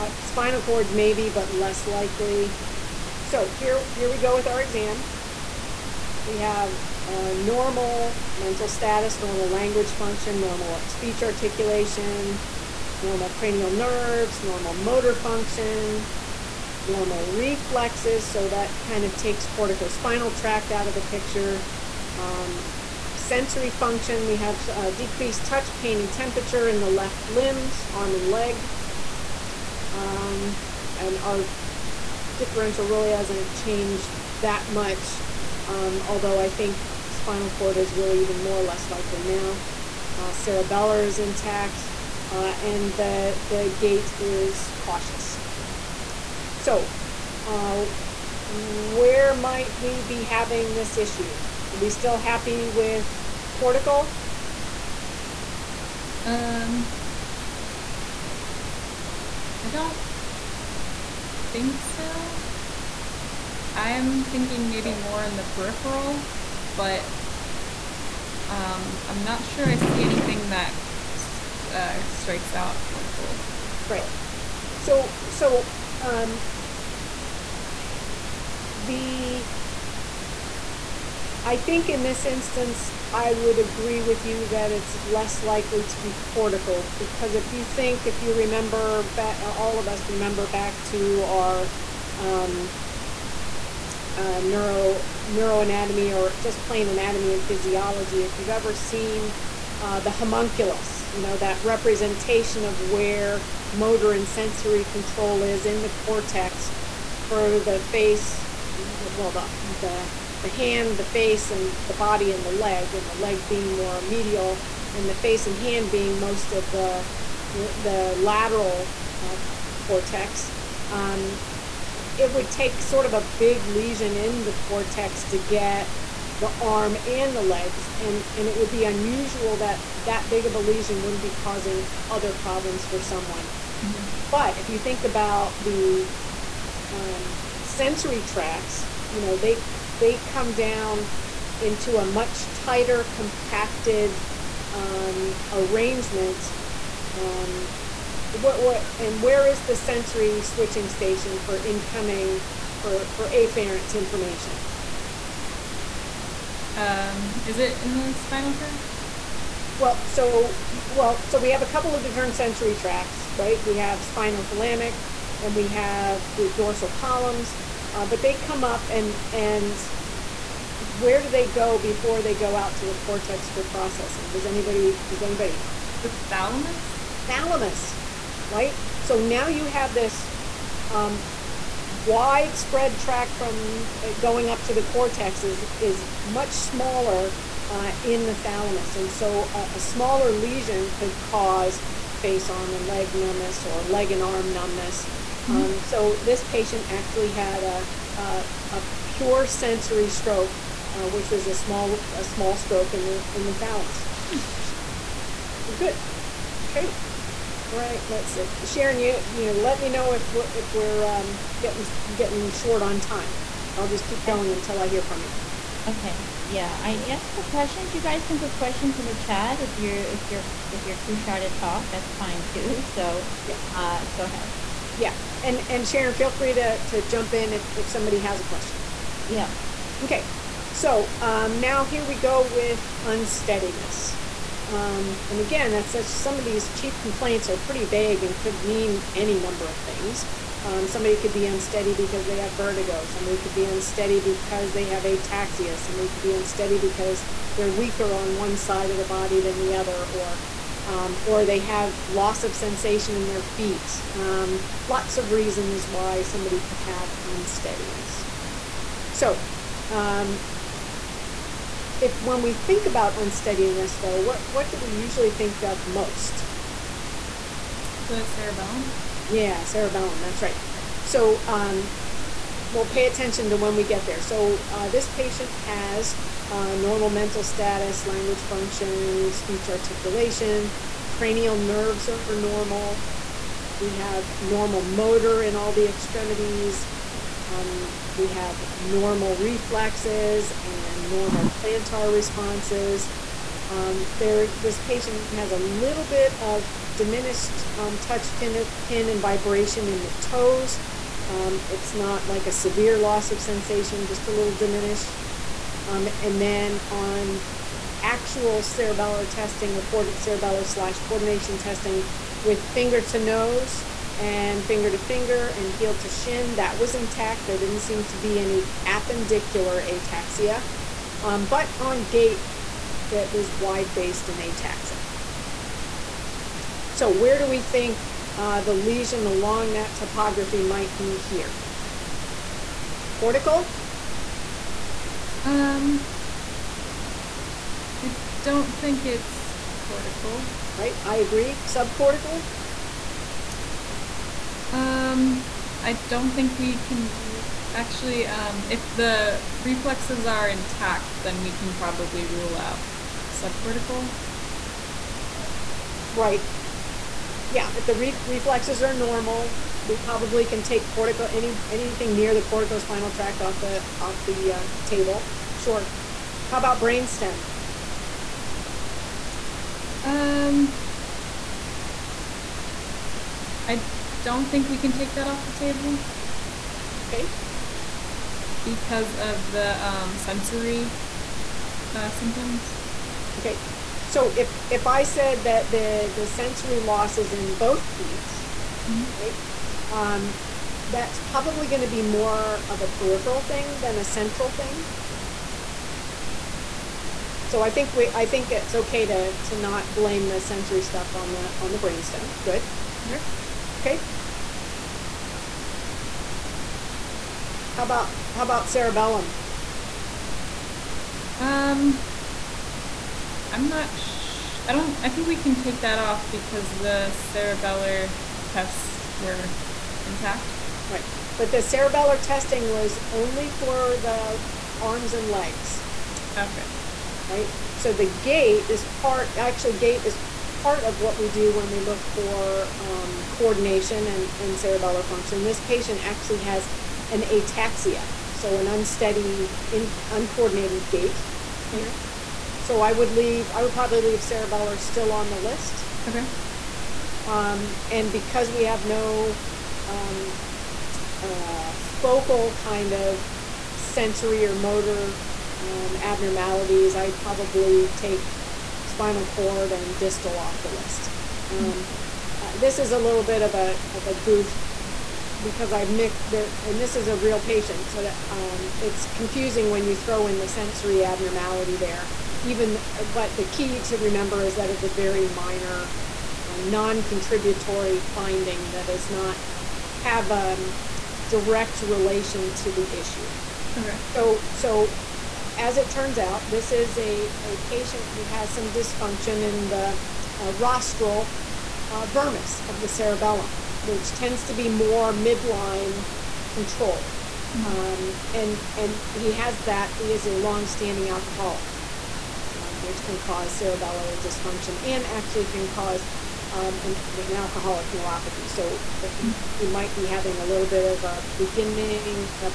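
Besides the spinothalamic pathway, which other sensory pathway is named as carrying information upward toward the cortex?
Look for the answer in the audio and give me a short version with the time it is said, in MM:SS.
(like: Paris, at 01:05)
dorsal columns, at 02:46.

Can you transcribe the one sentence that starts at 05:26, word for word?
So where do we think uh, the lesion along that topography might be here?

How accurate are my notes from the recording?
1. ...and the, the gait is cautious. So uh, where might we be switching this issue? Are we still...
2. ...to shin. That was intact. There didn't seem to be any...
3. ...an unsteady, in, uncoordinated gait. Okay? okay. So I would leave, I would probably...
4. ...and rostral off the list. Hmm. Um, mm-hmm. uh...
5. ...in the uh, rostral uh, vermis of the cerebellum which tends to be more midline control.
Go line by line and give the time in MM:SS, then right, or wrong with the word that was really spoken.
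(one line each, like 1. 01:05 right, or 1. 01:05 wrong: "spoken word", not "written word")
1. 00:42 wrong: "having", not "switching"
2. 05:15 right
3. 07:18 right
4. 07:39 wrong: "distal", not "rostral"
5. 08:09 right.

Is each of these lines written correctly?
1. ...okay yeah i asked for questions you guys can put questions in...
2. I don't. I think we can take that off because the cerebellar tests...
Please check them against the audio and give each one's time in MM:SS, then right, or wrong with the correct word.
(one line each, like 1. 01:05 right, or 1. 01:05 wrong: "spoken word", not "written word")
1. 03:35 right
2. 06:54 right.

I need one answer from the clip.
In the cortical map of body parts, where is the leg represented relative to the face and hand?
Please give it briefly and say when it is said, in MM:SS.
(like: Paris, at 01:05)
more medial, at 01:53.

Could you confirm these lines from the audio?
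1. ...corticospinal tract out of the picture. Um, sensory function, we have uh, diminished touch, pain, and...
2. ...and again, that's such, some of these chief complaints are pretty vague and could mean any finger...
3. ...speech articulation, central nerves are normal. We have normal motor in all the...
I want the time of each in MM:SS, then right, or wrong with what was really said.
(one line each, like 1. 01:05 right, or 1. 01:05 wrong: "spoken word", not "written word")
1. 00:19 wrong: "decreased", not "diminished"
2. 03:55 wrong: "number", not "finger"
3. 04:39 wrong: "cranial", not "central".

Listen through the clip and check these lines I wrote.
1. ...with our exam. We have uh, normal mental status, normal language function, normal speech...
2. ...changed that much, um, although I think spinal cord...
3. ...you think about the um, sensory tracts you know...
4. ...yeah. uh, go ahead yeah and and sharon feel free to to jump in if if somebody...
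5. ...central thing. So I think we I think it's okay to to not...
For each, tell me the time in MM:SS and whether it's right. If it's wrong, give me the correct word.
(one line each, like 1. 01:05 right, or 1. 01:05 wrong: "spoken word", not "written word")
1. 00:04 right
2. 00:33 right
3. 02:14 right
4. 03:43 right
5. 06:34 right.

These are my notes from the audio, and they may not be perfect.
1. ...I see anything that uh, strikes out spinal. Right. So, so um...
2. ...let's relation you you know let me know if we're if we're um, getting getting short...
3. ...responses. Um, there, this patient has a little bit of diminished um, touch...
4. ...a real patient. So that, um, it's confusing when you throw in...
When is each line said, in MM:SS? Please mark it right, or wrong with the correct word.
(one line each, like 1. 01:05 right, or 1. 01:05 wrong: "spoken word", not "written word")
1. 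01:09 wrong: "cortical", not "spinal"
2. 03:28 wrong: "sharon", not "relation"
3. 04:52 right
4. 07:47 right.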